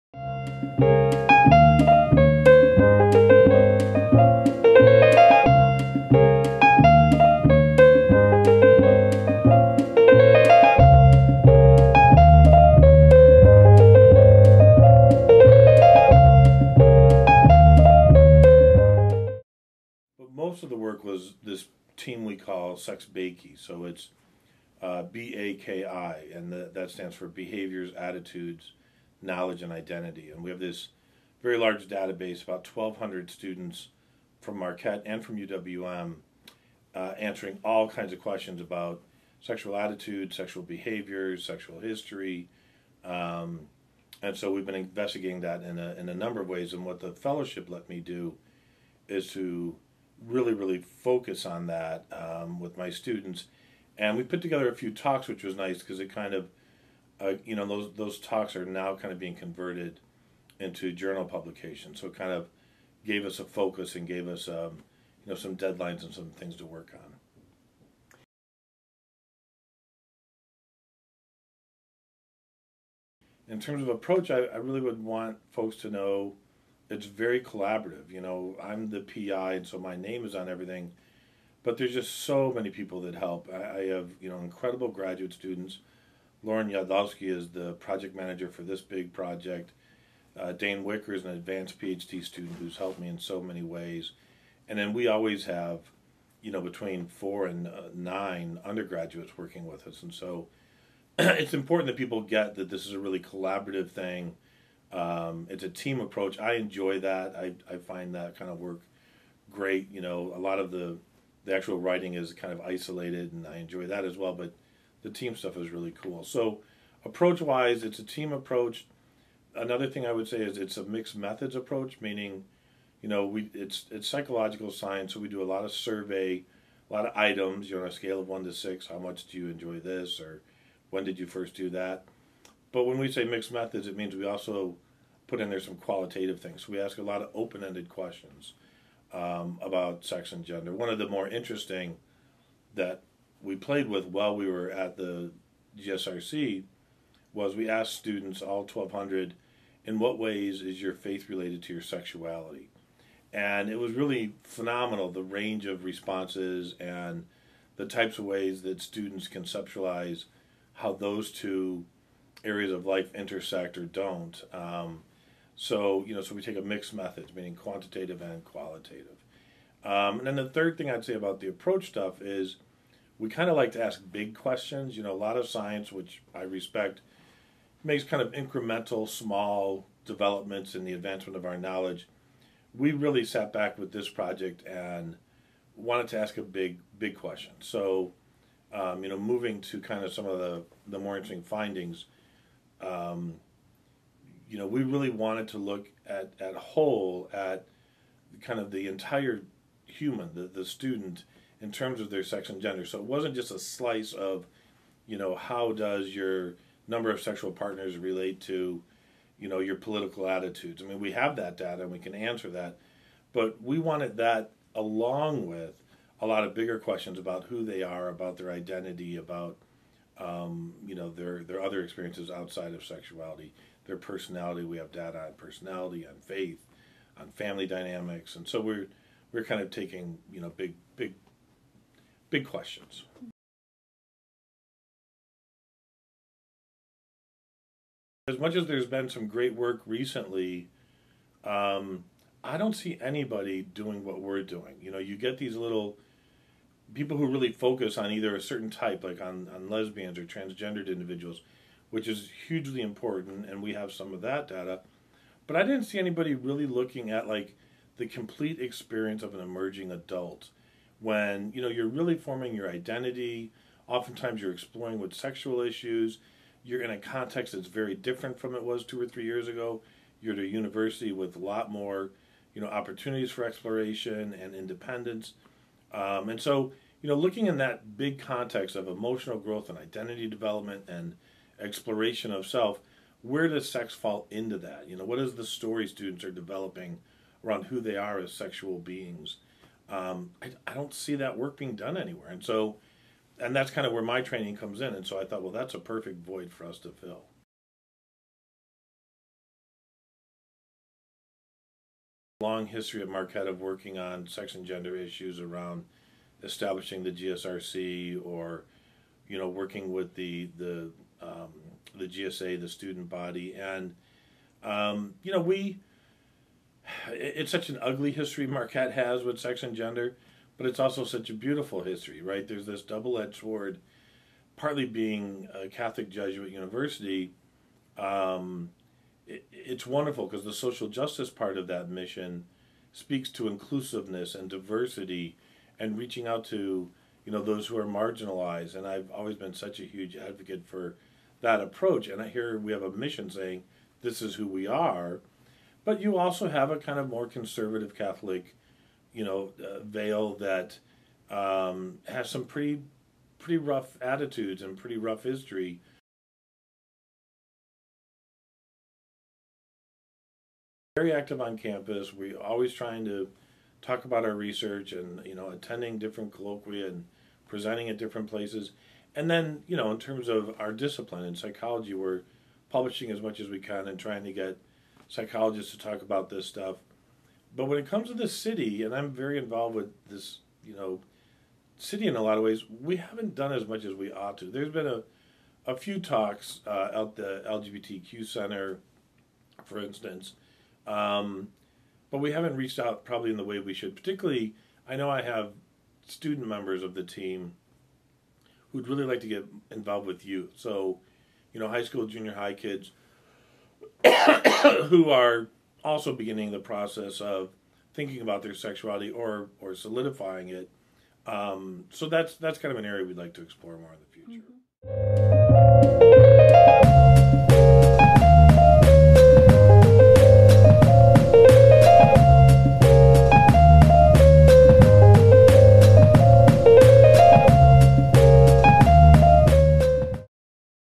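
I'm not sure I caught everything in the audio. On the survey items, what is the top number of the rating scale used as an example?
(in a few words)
6.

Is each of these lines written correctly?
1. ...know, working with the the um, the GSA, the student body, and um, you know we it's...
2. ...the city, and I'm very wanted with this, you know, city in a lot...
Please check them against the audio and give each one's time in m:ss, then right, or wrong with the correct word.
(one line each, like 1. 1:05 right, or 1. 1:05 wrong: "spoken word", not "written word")
1. 5:09 right
2. 6:18 wrong: "involved", not "wanted".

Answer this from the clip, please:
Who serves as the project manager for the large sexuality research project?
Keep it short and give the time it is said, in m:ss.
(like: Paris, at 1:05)
Lauren Yadlovsky, at 1:26.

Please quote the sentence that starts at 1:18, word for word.
You know, I'm the PI, and so my name is on everything, but there's just so many people that help.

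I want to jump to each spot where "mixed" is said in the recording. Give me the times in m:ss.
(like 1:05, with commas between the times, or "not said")
2:00, 2:13, 2:46.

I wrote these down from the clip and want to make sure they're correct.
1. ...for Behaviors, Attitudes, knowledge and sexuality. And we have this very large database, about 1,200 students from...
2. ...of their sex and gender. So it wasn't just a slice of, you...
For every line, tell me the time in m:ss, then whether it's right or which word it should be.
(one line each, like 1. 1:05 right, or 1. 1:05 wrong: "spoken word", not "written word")
1. 0:27 wrong: "identity", not "sexuality"
2. 3:22 right.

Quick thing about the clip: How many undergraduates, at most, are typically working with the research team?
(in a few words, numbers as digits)
9.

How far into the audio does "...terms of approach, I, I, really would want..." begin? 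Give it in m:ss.
1:13.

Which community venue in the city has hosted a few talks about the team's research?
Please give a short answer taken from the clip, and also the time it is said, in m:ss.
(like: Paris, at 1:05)
LGBTQ Center, at 6:27.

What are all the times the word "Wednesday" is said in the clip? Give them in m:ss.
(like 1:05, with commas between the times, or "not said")
not said.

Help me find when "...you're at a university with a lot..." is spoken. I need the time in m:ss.
4:30.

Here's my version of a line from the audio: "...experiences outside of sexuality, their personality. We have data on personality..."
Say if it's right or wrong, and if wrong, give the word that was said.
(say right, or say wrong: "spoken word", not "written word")
right.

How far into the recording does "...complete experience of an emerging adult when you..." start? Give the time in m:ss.
4:18.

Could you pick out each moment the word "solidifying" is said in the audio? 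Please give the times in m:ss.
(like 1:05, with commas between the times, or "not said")
6:49.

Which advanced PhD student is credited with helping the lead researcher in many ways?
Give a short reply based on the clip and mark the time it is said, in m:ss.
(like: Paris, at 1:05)
Dane Wicker, at 1:30.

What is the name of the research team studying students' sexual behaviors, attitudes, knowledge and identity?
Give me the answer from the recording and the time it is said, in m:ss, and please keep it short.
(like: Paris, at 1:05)
Sex BAKI, at 0:22.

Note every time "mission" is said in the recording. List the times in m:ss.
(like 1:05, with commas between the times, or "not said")
5:31, 5:42.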